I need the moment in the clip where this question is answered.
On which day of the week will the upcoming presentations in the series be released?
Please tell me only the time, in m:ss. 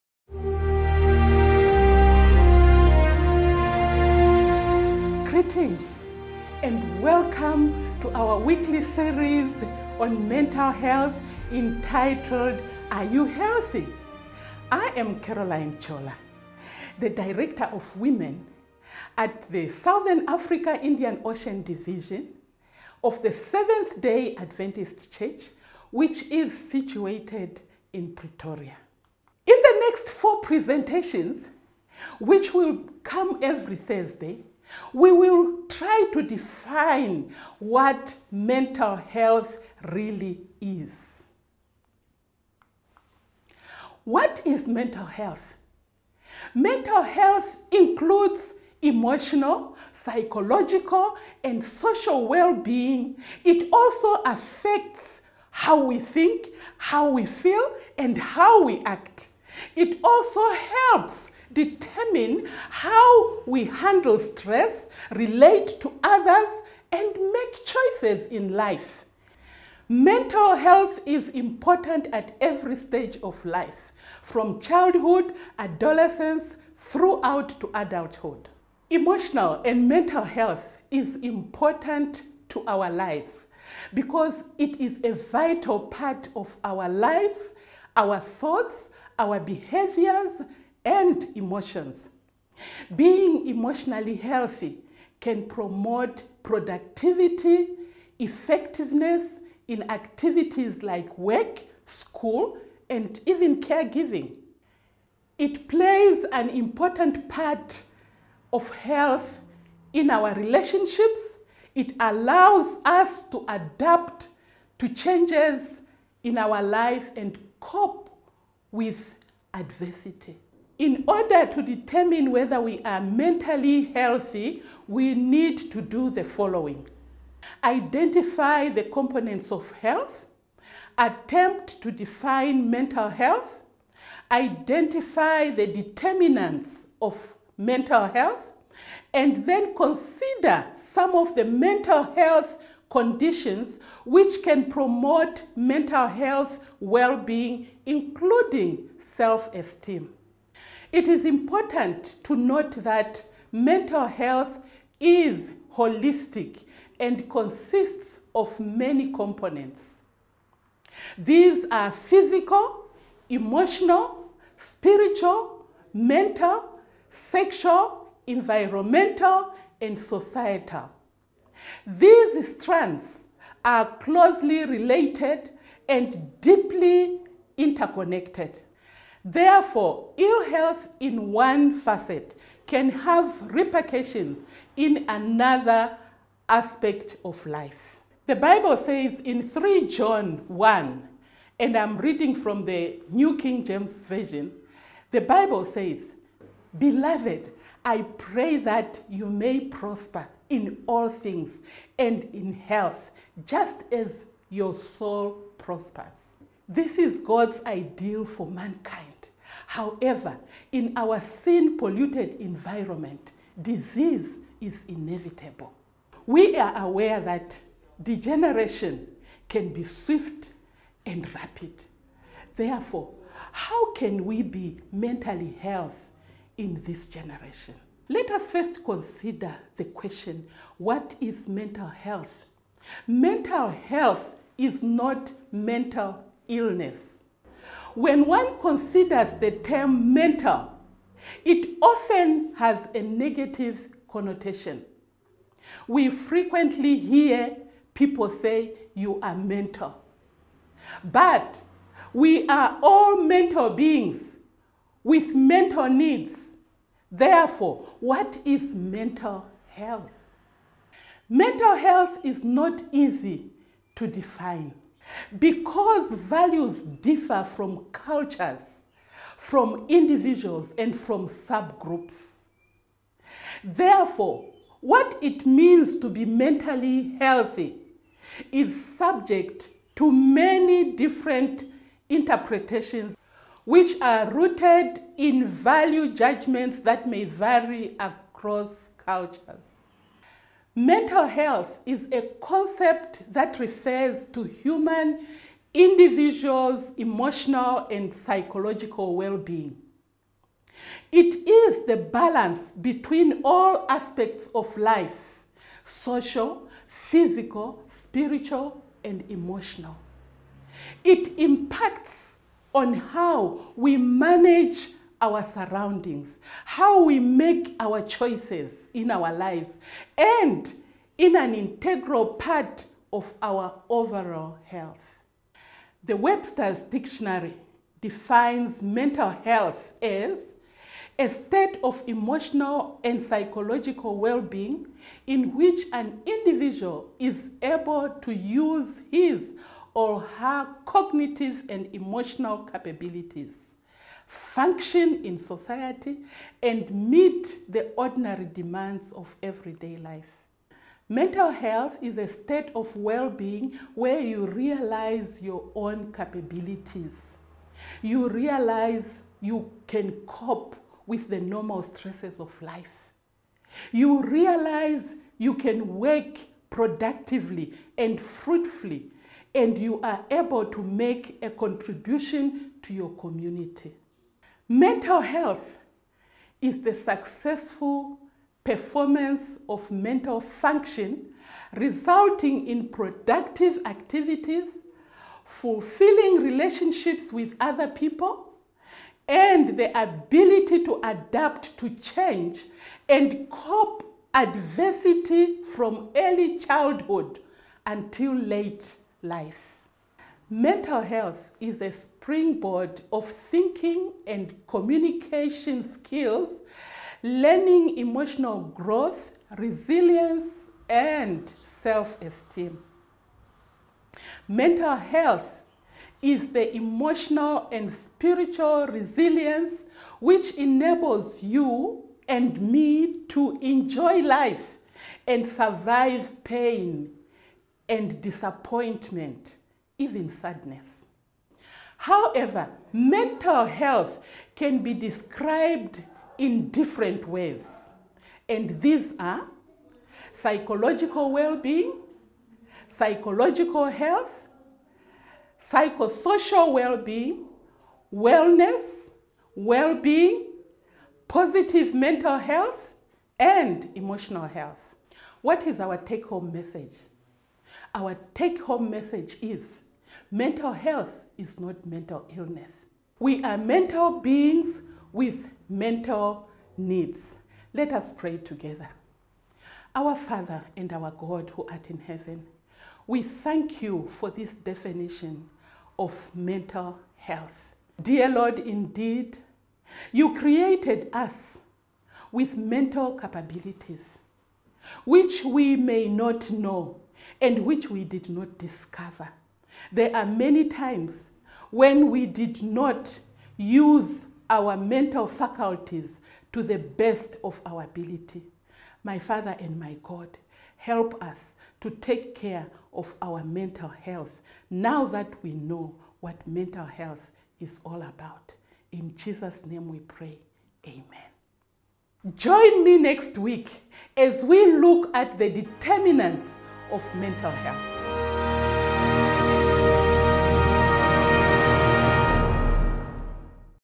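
0:33.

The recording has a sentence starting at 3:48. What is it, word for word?
Let us first consider the question what is mental health?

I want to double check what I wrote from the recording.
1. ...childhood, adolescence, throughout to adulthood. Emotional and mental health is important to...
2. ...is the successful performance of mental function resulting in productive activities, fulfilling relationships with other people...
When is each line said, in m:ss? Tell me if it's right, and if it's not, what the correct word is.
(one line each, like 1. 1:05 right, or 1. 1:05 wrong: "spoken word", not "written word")
1. 1:14 right
2. 6:16 right.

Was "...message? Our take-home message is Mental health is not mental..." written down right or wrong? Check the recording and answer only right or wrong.
right.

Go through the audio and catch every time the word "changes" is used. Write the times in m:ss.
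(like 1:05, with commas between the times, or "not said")
1:54, 6:31.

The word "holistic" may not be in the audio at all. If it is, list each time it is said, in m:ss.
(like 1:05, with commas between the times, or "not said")
2:35.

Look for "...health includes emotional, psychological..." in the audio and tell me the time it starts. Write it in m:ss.
0:47.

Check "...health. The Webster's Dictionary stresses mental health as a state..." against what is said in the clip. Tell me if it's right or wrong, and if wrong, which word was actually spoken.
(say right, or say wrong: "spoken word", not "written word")
wrong: "defines", not "stresses".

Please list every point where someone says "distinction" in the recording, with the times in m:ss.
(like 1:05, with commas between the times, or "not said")
not said.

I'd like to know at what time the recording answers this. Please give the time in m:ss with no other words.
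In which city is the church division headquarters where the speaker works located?
0:28.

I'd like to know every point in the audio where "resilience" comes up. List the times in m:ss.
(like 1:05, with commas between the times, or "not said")
6:49, 6:58.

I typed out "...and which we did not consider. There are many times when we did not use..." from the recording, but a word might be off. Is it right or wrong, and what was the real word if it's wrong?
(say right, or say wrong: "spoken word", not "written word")
wrong: "discover", not "consider".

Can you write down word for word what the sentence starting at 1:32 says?
Being emotionally healthy can promote productivity, effectiveness in activities like work, school, and even caregiving.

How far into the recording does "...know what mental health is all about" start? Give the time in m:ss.
8:25.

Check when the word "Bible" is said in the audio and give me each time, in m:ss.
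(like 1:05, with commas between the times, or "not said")
3:08, 3:15.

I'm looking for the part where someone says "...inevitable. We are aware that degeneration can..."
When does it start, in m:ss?
3:34.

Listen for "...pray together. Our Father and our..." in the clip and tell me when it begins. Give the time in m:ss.
7:48.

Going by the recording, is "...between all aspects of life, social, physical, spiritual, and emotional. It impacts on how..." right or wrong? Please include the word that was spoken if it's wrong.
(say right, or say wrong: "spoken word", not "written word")
right.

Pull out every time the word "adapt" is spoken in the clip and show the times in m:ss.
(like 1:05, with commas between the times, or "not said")
1:53, 6:31.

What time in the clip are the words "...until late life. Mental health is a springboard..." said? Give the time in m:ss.
6:37.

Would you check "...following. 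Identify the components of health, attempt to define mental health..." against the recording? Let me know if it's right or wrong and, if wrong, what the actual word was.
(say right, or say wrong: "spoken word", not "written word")
right.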